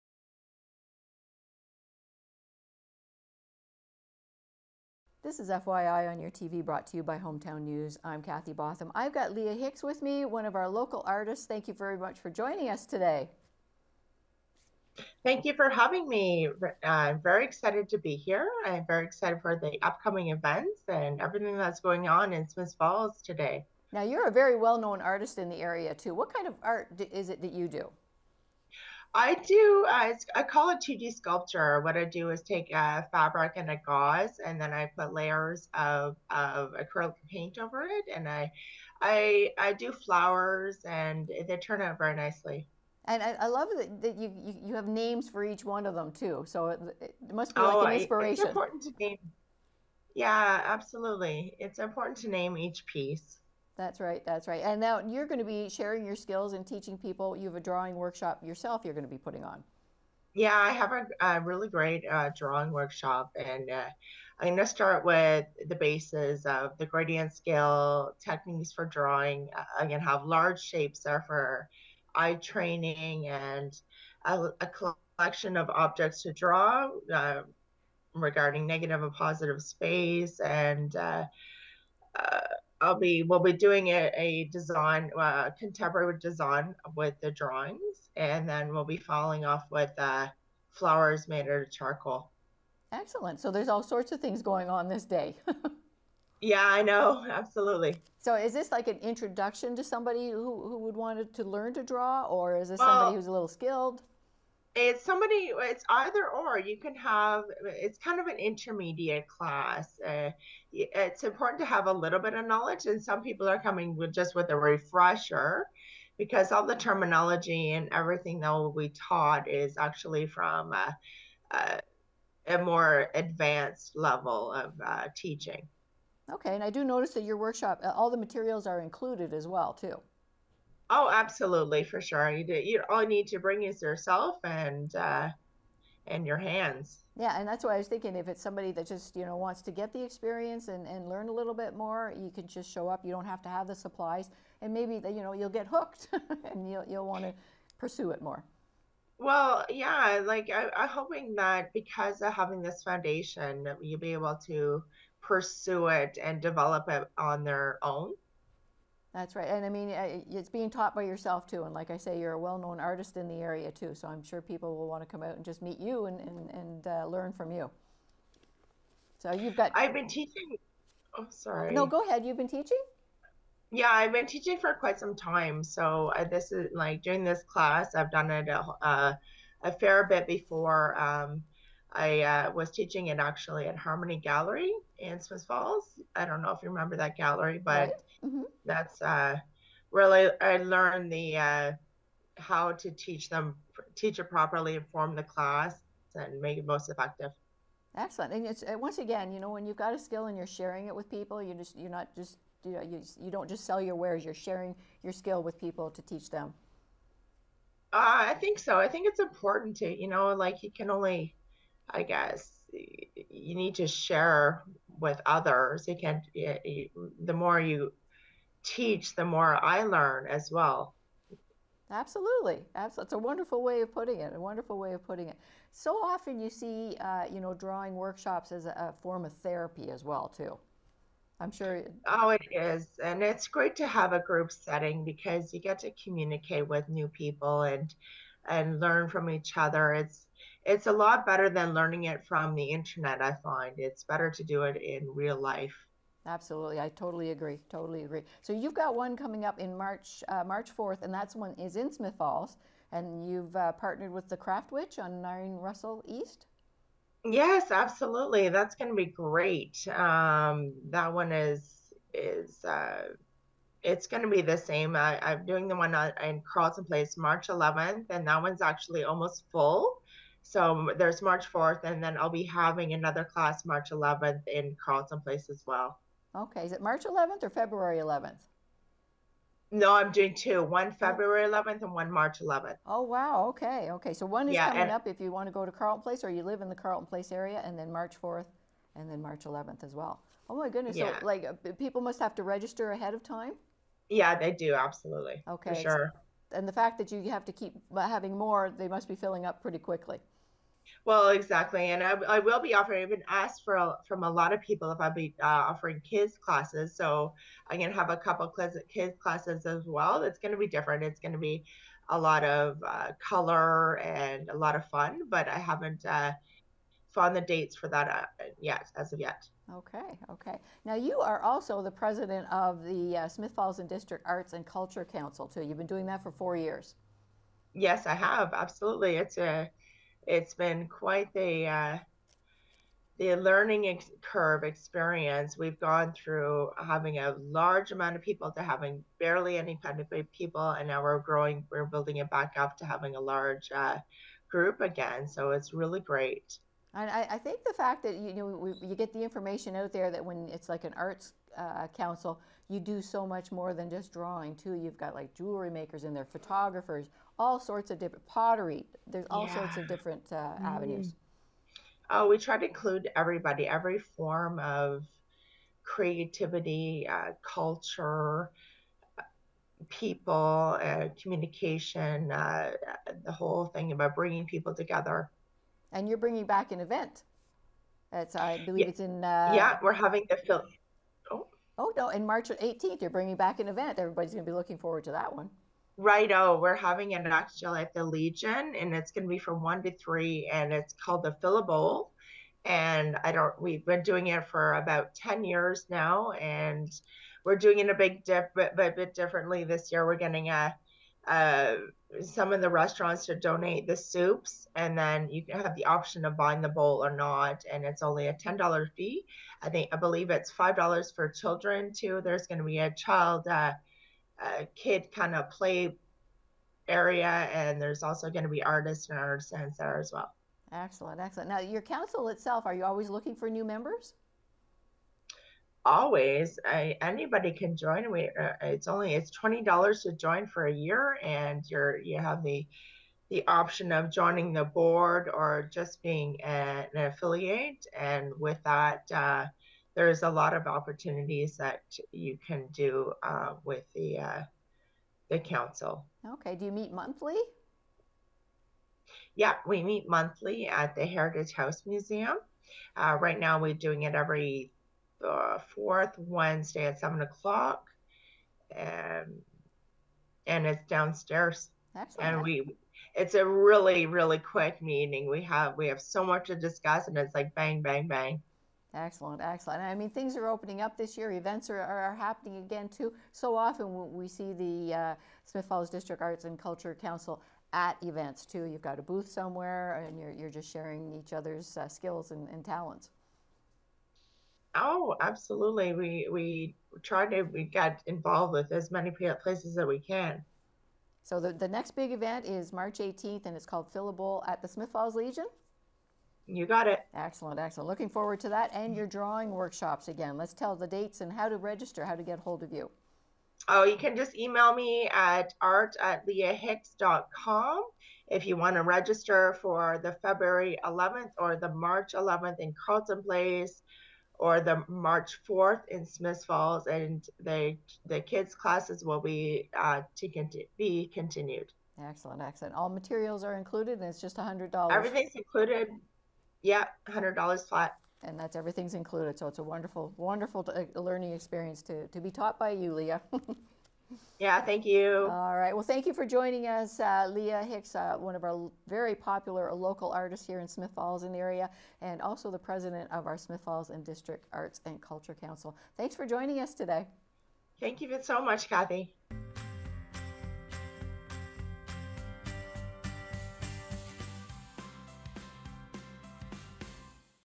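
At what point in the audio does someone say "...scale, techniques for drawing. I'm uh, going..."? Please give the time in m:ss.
1:07.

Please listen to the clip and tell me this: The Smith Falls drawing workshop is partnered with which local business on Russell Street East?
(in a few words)
The Craft Witch.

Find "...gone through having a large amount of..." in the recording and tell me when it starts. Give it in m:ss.
5:35.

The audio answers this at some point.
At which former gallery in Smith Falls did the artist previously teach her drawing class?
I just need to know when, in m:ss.
3:03.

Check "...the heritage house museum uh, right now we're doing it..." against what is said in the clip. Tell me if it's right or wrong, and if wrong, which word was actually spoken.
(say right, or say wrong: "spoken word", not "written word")
right.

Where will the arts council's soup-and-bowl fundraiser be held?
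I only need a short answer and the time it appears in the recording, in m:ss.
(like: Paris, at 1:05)
the Legion, at 6:27.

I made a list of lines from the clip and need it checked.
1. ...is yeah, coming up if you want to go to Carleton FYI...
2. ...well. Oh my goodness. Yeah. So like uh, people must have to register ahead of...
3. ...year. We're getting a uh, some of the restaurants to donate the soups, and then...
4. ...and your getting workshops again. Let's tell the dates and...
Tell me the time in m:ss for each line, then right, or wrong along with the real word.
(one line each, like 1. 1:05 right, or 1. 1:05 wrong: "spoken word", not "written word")
1. 4:44 wrong: "Place", not "FYI"
2. 4:49 right
3. 6:39 right
4. 8:18 wrong: "drawing", not "getting".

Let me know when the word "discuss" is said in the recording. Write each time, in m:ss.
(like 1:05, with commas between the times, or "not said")
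7:46.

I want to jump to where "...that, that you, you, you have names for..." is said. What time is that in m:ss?
0:43.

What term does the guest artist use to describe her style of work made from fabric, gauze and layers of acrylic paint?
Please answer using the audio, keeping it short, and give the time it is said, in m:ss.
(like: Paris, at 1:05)
2D sculpture, at 0:30.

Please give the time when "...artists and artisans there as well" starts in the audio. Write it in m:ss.
6:58.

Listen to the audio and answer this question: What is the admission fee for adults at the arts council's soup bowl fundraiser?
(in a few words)
$10.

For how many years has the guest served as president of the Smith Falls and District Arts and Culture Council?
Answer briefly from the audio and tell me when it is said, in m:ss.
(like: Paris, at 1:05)
4 years, at 5:26.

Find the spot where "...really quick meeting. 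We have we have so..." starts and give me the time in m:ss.
7:44.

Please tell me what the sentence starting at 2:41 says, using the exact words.
And like I say, you're a well known artist in the area too.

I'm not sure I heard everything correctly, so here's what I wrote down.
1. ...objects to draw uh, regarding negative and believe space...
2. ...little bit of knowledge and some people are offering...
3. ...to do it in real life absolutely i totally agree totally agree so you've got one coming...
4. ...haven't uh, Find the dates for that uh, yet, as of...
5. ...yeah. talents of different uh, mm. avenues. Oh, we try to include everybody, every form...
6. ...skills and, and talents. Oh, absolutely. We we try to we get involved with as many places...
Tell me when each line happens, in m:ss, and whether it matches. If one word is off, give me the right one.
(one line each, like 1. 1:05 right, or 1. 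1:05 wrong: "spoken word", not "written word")
1. 1:15 wrong: "positive", not "believe"
2. 1:51 wrong: "coming", not "offering"
3. 4:04 right
4. 5:15 right
5. 5:59 wrong: "sorts", not "talents"
6. 8:01 right.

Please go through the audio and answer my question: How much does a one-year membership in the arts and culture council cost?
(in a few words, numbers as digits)
$20.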